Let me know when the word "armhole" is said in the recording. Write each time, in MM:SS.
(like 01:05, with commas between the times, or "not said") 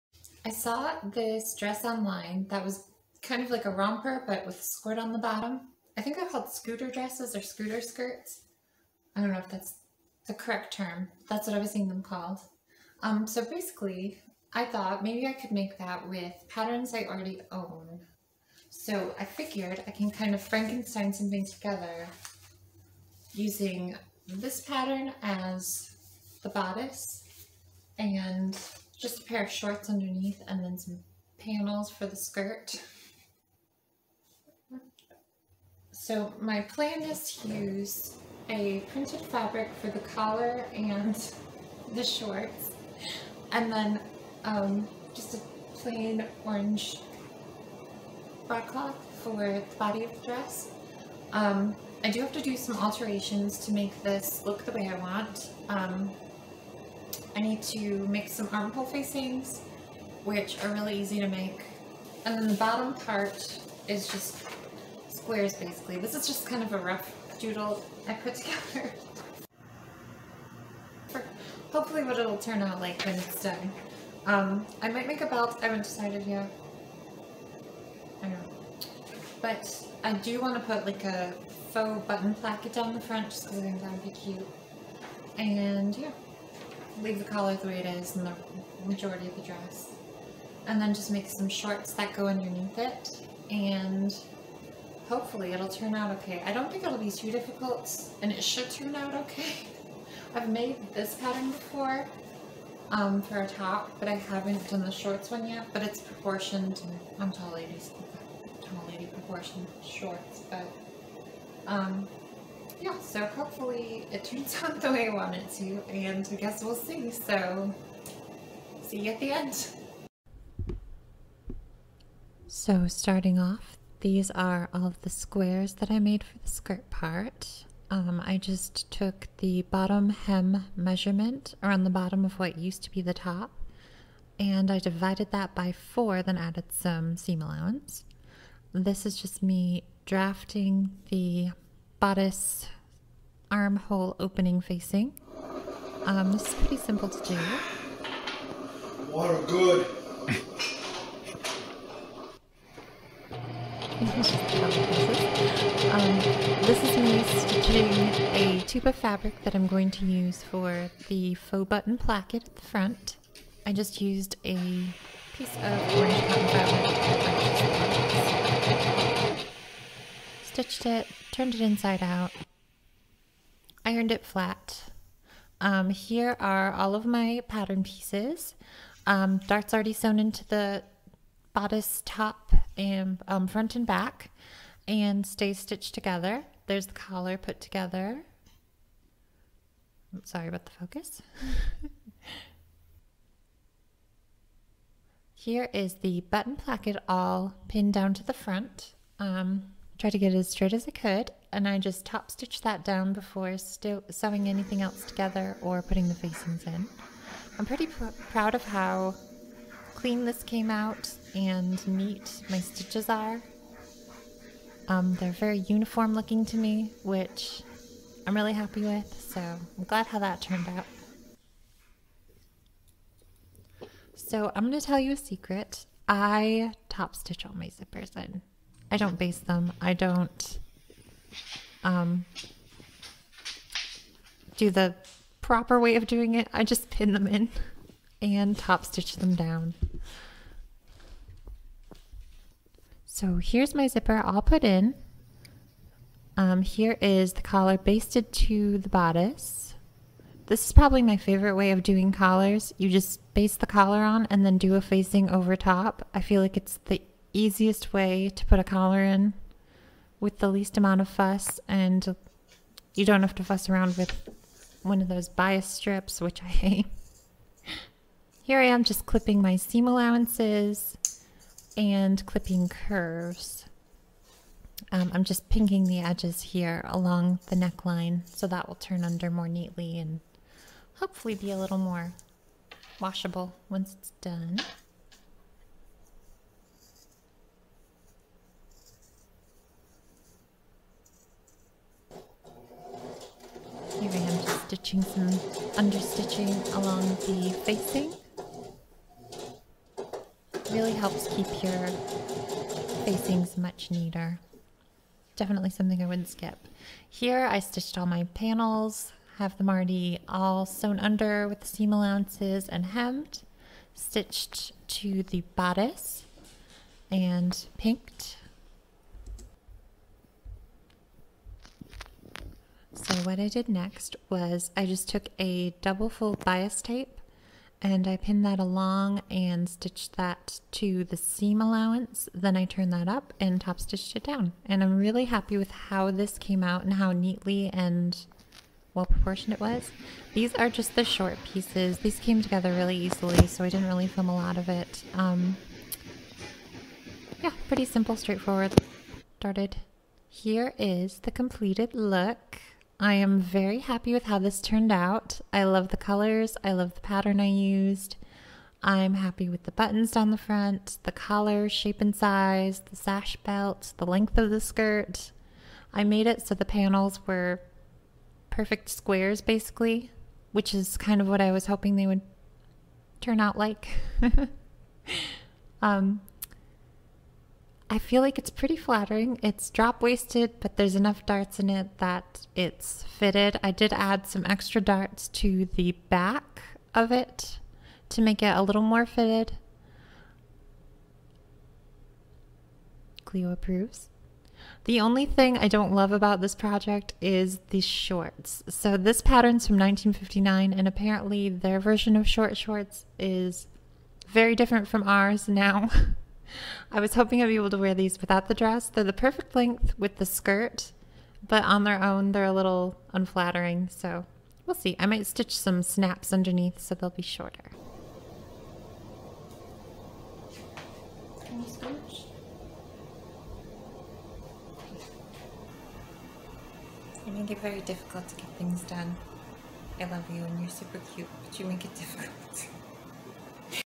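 00:58, 02:23.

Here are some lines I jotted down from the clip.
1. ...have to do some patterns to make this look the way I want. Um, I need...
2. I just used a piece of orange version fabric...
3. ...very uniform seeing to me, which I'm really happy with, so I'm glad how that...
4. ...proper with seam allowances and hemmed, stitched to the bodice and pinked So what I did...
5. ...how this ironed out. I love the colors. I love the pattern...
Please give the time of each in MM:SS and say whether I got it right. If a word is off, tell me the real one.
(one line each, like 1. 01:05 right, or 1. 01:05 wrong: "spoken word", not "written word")
1. 00:52 wrong: "alterations", not "patterns"
2. 02:43 wrong: "cotton", not "version"
3. 03:35 wrong: "looking", not "seeing"
4. 05:10 wrong: "under", not "proper"
5. 05:54 wrong: "turned", not "ironed".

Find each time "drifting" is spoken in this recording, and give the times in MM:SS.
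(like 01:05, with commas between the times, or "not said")
not said.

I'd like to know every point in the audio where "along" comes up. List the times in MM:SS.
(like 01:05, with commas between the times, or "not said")
04:36, 04:56, 05:28.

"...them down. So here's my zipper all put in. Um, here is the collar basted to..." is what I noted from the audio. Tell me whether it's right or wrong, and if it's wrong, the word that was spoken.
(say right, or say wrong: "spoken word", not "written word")
right.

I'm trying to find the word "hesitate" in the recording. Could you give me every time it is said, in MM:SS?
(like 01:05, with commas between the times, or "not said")
not said.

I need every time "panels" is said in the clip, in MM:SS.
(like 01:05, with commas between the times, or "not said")
00:31, 05:08, 06:06.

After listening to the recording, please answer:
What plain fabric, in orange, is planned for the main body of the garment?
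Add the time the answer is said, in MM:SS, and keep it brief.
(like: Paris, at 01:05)
broadcloth, at 00:48.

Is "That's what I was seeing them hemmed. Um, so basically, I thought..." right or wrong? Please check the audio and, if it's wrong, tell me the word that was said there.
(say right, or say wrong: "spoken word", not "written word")
wrong: "called", not "hemmed".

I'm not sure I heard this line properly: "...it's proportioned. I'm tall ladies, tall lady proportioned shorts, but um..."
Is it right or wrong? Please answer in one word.
right.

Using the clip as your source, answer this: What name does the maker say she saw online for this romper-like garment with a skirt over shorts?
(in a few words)
scooter dresses.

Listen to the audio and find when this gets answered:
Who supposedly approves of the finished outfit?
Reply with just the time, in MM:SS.
06:33.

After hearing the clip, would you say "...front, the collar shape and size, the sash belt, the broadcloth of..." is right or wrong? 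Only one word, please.
wrong.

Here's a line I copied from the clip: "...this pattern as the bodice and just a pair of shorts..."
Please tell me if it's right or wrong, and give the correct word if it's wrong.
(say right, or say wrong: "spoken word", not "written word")
right.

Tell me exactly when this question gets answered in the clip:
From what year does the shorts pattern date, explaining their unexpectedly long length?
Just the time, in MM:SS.
06:39.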